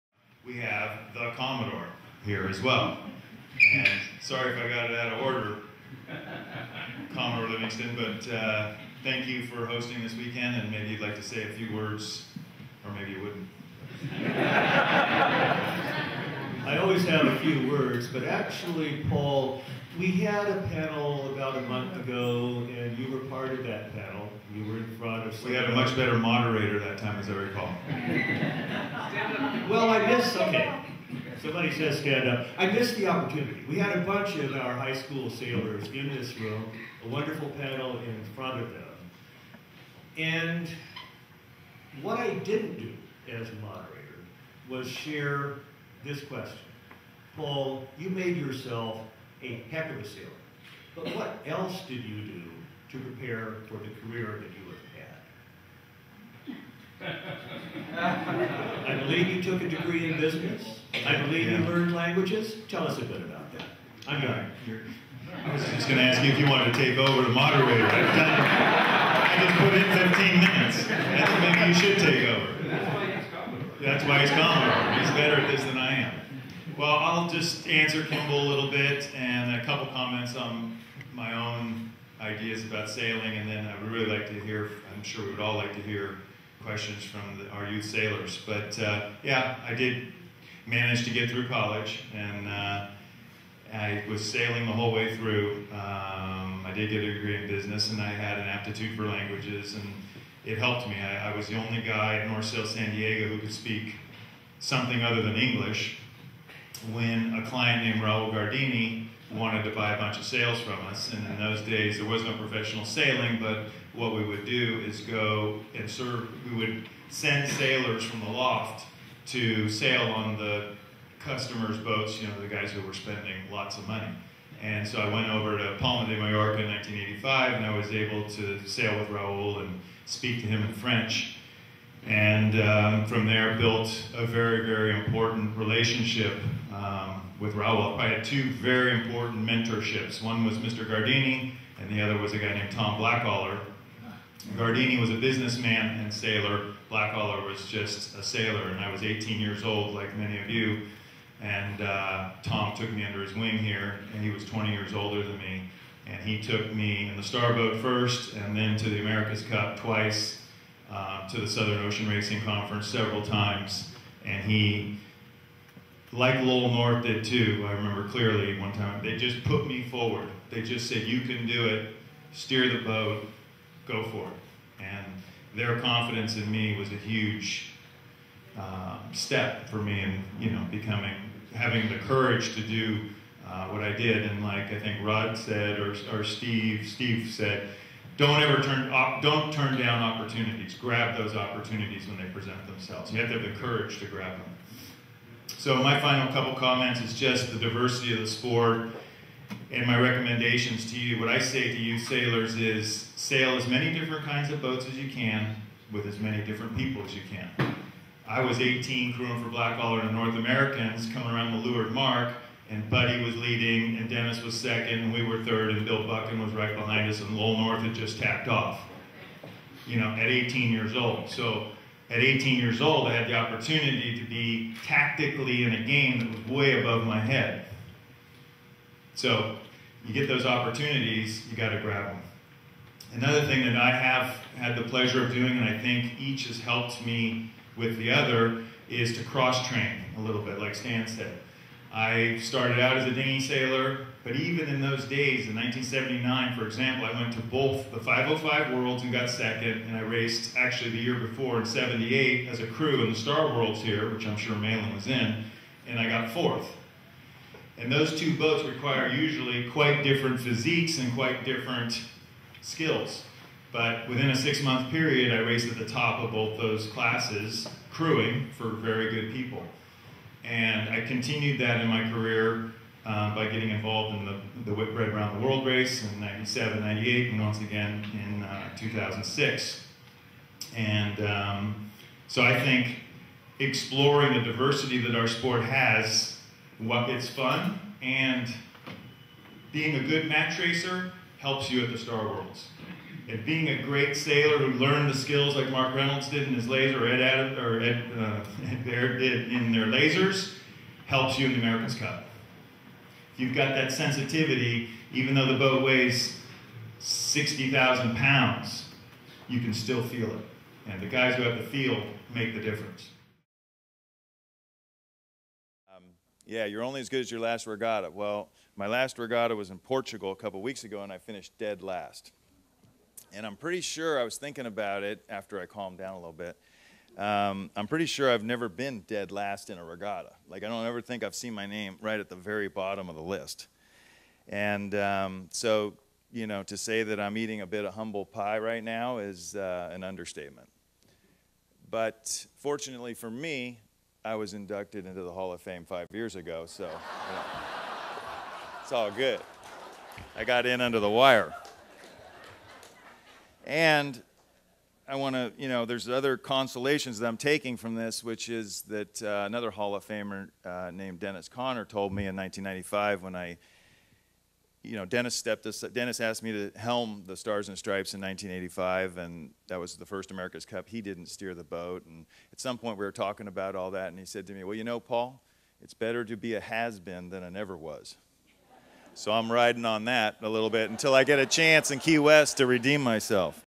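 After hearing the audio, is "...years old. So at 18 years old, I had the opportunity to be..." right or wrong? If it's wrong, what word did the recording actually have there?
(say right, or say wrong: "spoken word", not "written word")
right.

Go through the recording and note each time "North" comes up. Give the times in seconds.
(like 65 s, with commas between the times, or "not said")
102 s, 166 s, 210 s, 217 s.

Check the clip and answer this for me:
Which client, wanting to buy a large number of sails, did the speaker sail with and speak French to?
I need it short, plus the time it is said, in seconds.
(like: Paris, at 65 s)
Raul Gardini, at 108 s.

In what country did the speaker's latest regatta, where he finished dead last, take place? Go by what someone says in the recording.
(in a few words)
Portugal.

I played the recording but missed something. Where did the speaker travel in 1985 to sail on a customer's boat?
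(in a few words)
Palma de Mallorca.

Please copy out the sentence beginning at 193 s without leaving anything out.
You have to have the courage to grab them.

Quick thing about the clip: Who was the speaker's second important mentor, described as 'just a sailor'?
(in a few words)
Tom Blackaller.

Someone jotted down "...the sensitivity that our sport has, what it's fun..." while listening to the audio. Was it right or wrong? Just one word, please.
wrong.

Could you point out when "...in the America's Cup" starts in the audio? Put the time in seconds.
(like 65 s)
301 s.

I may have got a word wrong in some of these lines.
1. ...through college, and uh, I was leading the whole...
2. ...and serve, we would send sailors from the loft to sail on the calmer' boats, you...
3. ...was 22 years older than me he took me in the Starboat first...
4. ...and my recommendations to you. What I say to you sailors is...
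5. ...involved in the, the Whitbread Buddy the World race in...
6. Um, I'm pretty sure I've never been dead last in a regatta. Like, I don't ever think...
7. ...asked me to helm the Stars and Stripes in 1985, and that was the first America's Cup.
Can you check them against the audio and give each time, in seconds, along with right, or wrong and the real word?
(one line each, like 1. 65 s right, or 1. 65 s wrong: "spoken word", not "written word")
1. 91 s wrong: "sailing", not "leading"
2. 115 s wrong: "customers", not "calmer"
3. 154 s wrong: "20", not "22"
4. 199 s right
5. 273 s wrong: "Around", not "Buddy"
6. 327 s right
7. 366 s right.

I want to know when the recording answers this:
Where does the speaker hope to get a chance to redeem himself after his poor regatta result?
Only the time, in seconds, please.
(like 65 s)
381 s.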